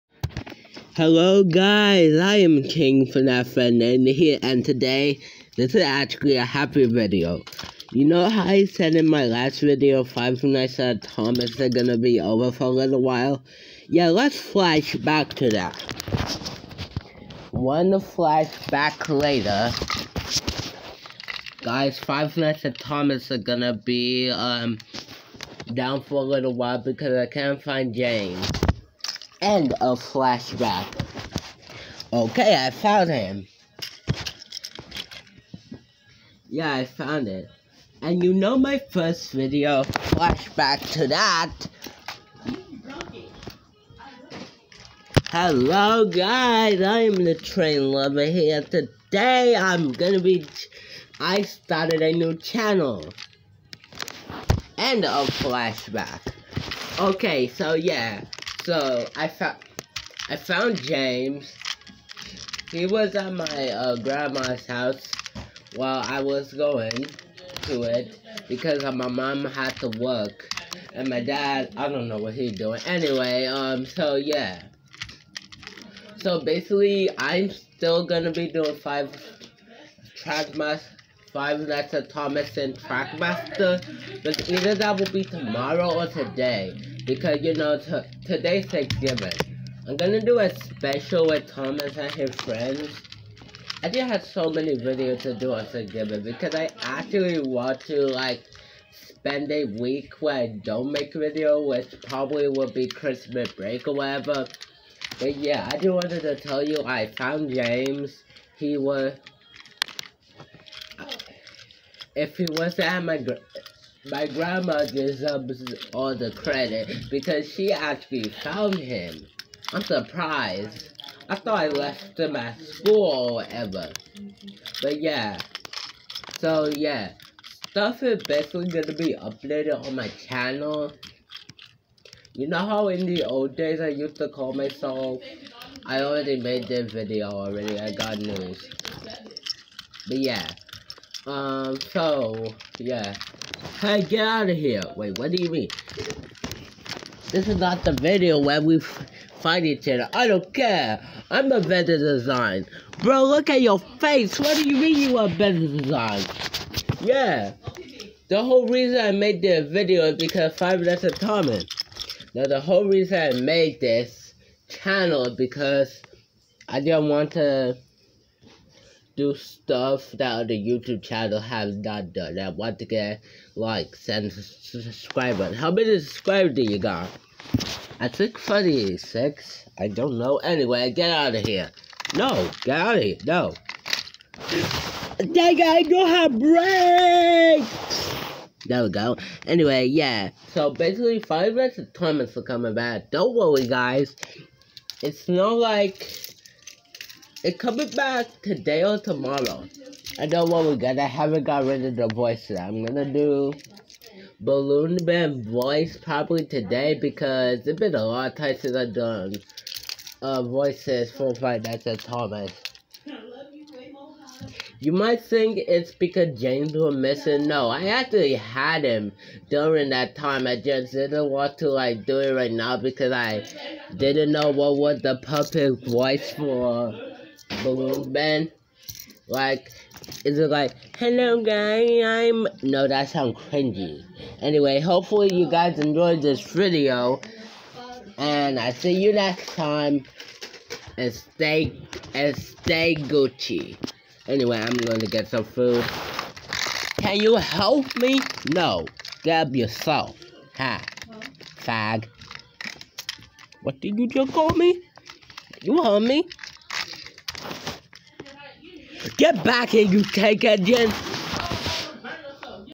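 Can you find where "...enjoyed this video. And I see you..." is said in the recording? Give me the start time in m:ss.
3:55.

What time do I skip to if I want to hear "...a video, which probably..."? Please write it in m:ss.
1:41.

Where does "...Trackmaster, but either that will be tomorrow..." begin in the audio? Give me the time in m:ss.
1:22.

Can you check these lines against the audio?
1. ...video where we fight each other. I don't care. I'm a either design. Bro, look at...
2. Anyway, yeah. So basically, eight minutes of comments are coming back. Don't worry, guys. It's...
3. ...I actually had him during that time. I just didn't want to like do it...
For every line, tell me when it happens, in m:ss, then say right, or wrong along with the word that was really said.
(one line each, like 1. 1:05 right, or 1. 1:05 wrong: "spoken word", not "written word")
1. 2:27 wrong: "better", not "either"
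2. 3:09 wrong: "five", not "eight"
3. 3:37 right.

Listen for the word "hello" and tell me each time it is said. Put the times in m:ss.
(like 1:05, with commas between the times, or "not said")
0:00, 0:45, 3:50.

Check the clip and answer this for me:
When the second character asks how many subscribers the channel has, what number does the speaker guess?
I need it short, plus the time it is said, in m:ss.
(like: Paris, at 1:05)
36, at 2:58.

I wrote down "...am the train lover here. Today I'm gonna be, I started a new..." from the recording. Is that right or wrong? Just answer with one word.
right.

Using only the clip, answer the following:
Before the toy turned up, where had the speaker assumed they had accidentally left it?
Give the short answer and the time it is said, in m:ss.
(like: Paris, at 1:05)
School, at 2:02.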